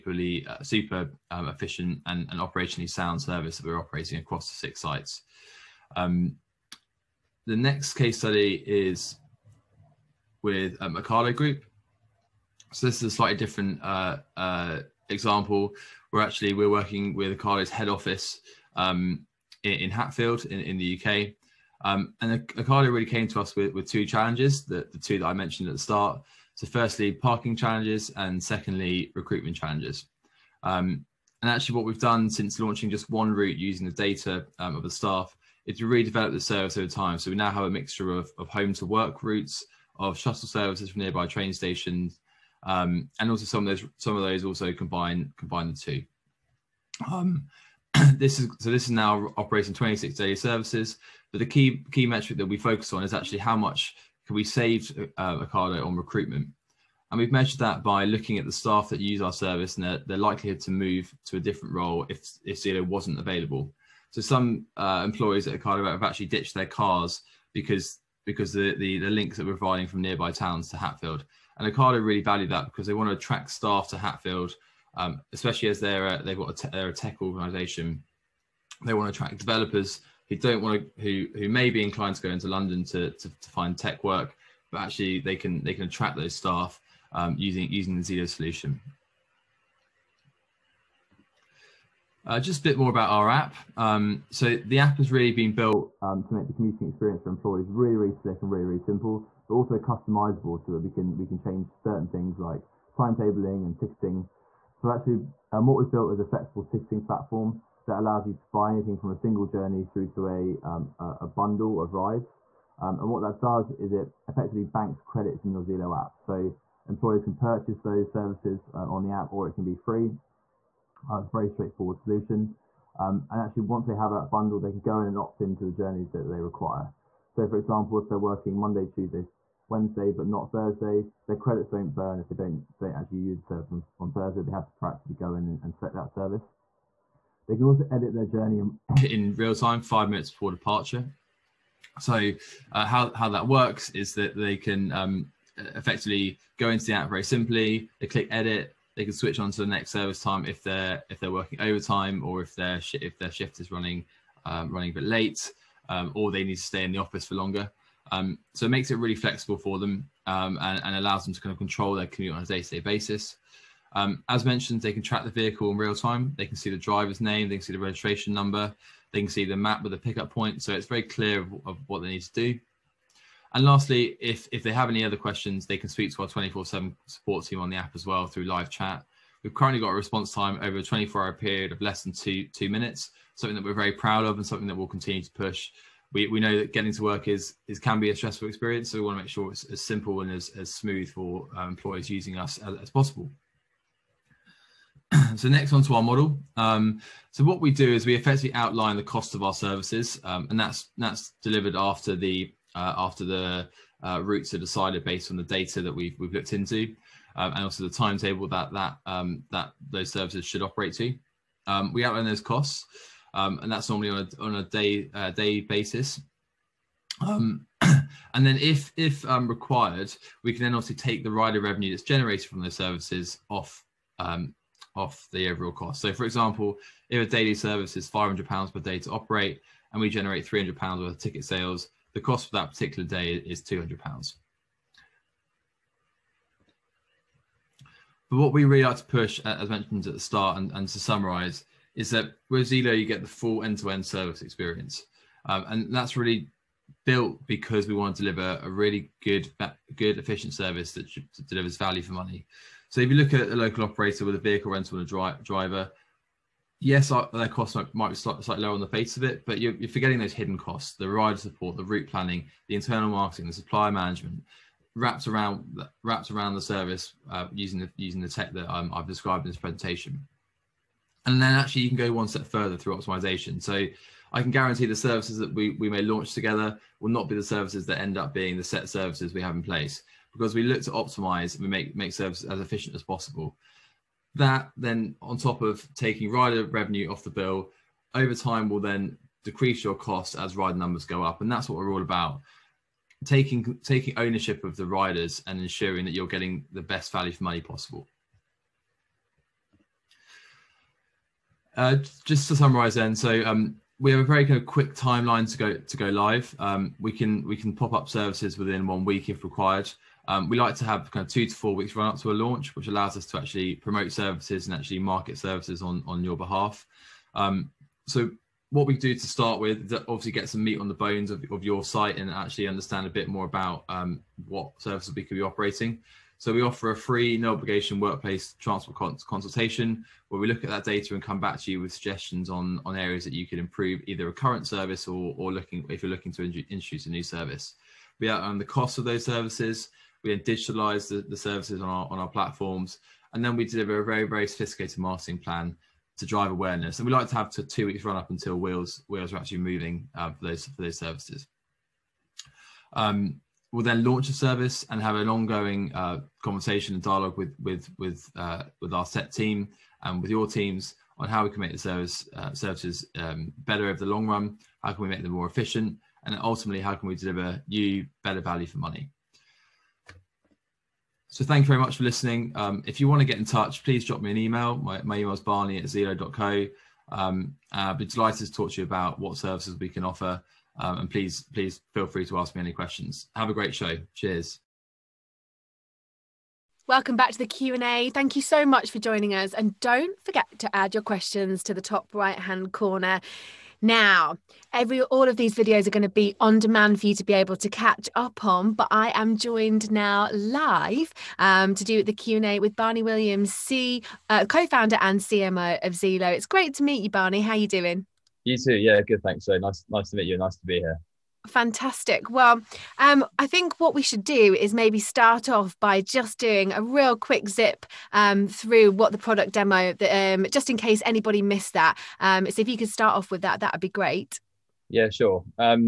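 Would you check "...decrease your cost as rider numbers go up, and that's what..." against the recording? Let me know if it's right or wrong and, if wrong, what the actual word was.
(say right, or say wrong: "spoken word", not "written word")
right.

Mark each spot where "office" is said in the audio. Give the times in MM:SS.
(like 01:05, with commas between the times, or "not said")
00:17, 02:36.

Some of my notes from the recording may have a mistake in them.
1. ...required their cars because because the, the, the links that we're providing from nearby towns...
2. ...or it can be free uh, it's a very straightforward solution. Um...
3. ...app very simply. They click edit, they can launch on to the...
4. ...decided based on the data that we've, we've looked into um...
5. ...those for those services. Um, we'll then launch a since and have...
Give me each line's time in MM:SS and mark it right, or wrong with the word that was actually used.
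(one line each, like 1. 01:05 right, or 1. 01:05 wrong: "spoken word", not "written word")
1. 01:06 wrong: "ditched", not "required"
2. 01:59 right
3. 02:26 wrong: "switch", not "launch"
4. 03:24 right
5. 05:50 wrong: "service", not "since".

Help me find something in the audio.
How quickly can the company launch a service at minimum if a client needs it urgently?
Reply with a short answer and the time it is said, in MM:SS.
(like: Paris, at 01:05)
within one week, at 05:08.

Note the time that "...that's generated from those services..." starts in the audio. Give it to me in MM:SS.
03:41.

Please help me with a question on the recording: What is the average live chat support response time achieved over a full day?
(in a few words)
less than 2 minutes.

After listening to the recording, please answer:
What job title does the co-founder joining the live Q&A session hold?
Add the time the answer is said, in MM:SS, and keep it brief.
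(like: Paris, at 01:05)
CMO, at 06:45.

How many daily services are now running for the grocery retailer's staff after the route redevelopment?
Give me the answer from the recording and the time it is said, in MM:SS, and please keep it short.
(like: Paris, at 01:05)
26, at 00:49.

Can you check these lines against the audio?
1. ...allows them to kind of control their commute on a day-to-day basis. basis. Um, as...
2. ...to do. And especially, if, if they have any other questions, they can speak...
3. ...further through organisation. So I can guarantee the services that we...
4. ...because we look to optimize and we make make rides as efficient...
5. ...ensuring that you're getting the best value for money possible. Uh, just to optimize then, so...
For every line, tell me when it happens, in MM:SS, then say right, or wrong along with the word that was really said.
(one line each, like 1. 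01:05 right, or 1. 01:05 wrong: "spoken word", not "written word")
1. 02:40 right
2. 02:52 wrong: "lastly", not "especially"
3. 04:32 wrong: "optimization", not "organisation"
4. 04:40 wrong: "services", not "rides"
5. 04:55 wrong: "summarize", not "optimize".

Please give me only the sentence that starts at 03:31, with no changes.
Um, we outline those costs, um, and that's normally on a, on a day uh, day basis.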